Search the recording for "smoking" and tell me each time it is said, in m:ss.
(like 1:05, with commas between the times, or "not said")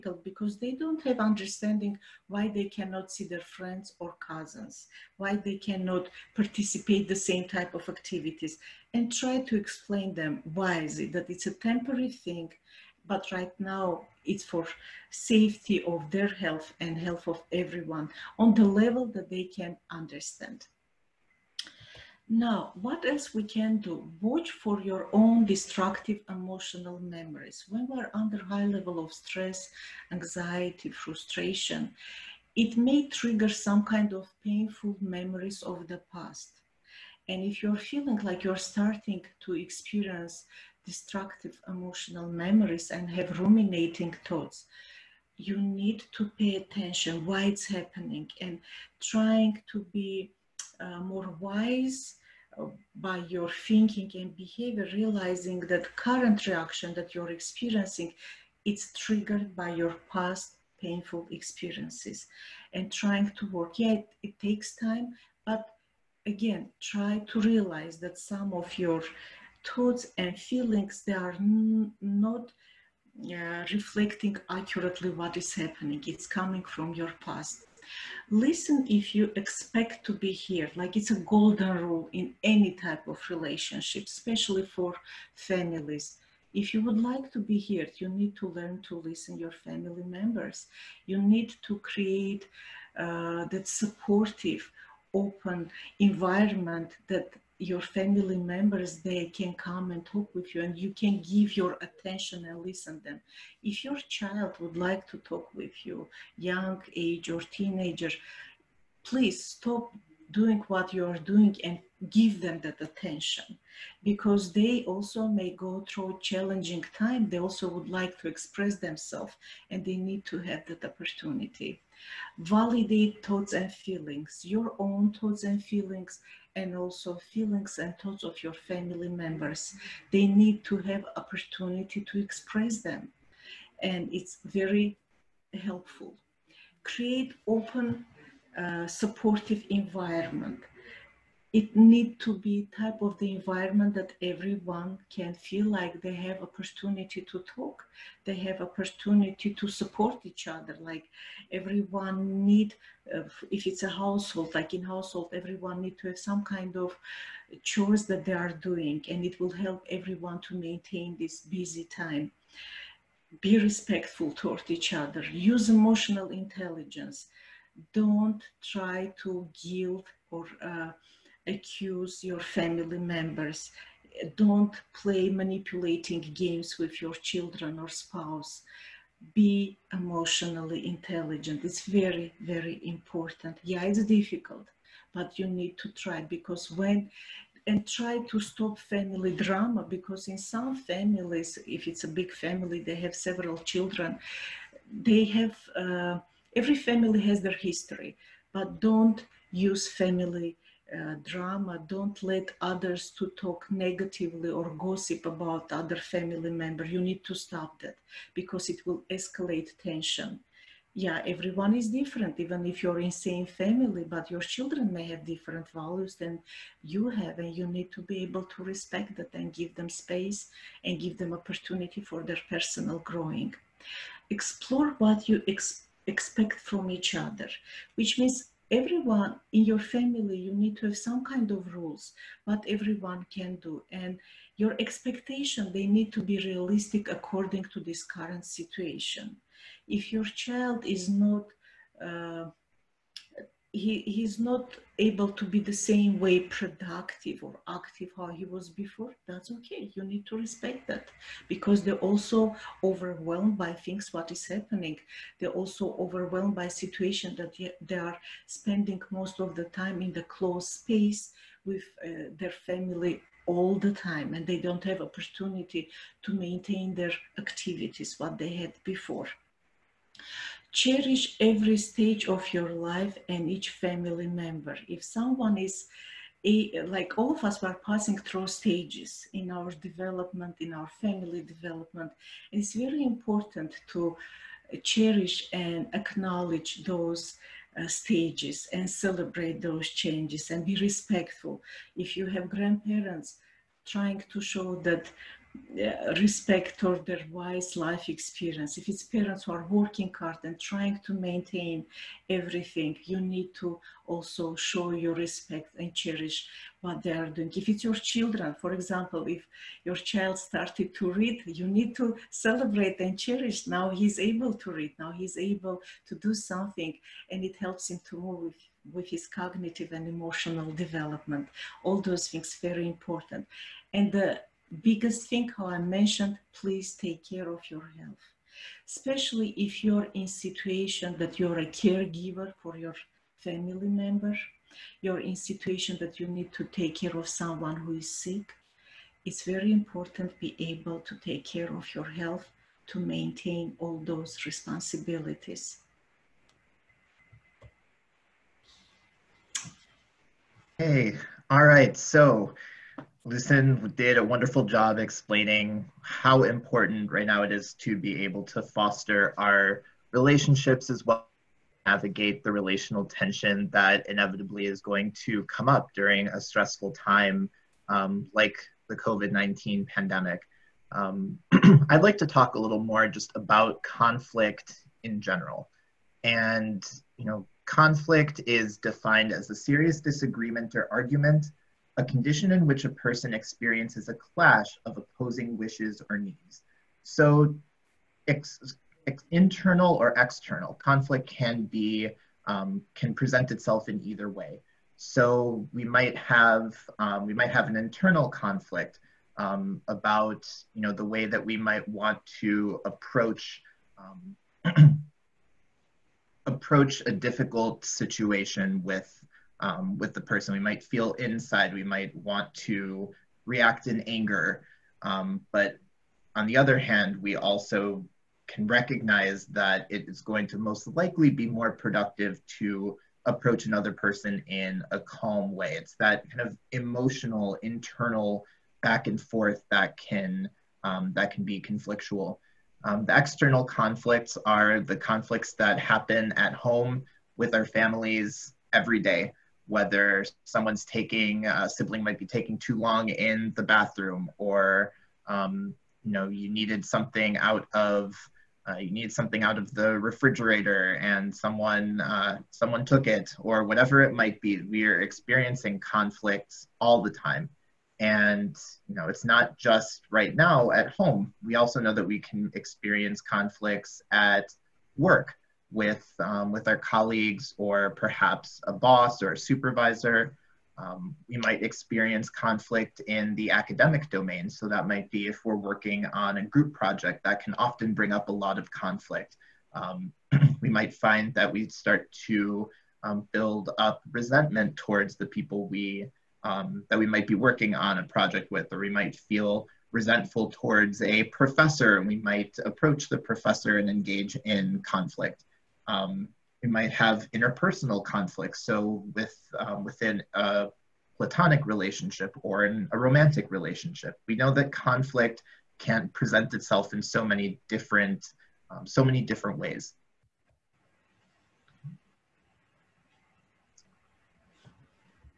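not said.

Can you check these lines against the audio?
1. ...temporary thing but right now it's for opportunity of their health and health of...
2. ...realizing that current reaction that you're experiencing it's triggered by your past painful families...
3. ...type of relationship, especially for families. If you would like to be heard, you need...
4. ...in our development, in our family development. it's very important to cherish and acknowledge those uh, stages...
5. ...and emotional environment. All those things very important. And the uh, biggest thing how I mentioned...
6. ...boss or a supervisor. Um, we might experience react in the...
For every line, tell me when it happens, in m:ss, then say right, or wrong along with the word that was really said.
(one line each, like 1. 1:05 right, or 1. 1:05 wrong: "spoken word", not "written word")
1. 0:11 wrong: "safety", not "opportunity"
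2. 0:54 wrong: "experiences", not "families"
3. 1:22 right
4. 4:39 right
5. 5:19 wrong: "development", not "environment"
6. 7:48 wrong: "conflict", not "react".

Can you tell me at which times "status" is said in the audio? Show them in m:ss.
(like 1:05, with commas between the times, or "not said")
not said.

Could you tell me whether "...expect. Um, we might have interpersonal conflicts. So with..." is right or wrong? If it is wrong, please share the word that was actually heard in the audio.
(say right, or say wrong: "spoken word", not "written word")
wrong: "conflict", not "expect".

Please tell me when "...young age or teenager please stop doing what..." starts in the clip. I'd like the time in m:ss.
1:46.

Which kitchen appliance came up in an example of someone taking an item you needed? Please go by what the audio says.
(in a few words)
refrigerator.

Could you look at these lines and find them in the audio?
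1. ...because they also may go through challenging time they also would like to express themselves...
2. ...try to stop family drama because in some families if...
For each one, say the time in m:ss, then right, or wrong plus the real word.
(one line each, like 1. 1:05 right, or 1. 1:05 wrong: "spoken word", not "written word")
1. 1:54 right
2. 3:07 right.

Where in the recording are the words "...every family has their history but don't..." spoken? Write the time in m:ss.
3:16.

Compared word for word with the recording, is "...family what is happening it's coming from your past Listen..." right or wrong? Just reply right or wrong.
wrong.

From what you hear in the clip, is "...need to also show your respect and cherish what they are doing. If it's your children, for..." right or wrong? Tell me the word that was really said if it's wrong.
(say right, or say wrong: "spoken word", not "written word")
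right.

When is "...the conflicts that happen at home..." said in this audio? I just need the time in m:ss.
7:14.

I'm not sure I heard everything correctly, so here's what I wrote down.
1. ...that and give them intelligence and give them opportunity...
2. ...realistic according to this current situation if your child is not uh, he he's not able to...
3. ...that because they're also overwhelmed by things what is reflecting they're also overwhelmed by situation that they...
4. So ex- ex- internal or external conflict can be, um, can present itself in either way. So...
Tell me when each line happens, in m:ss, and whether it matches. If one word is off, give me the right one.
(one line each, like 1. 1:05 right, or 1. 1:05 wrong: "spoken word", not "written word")
1. 3:39 wrong: "space", not "intelligence"
2. 3:56 right
3. 4:10 wrong: "happening", not "reflecting"
4. 6:27 right.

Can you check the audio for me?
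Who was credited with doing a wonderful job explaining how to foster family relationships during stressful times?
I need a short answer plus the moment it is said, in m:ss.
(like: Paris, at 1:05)
Lucin, at 5:53.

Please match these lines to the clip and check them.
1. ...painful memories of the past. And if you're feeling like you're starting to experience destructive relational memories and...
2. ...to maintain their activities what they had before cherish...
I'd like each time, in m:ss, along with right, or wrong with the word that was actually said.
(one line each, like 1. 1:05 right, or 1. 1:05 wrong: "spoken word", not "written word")
1. 0:34 wrong: "emotional", not "relational"
2. 4:26 right.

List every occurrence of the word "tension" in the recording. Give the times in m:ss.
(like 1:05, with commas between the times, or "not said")
3:29, 6:03.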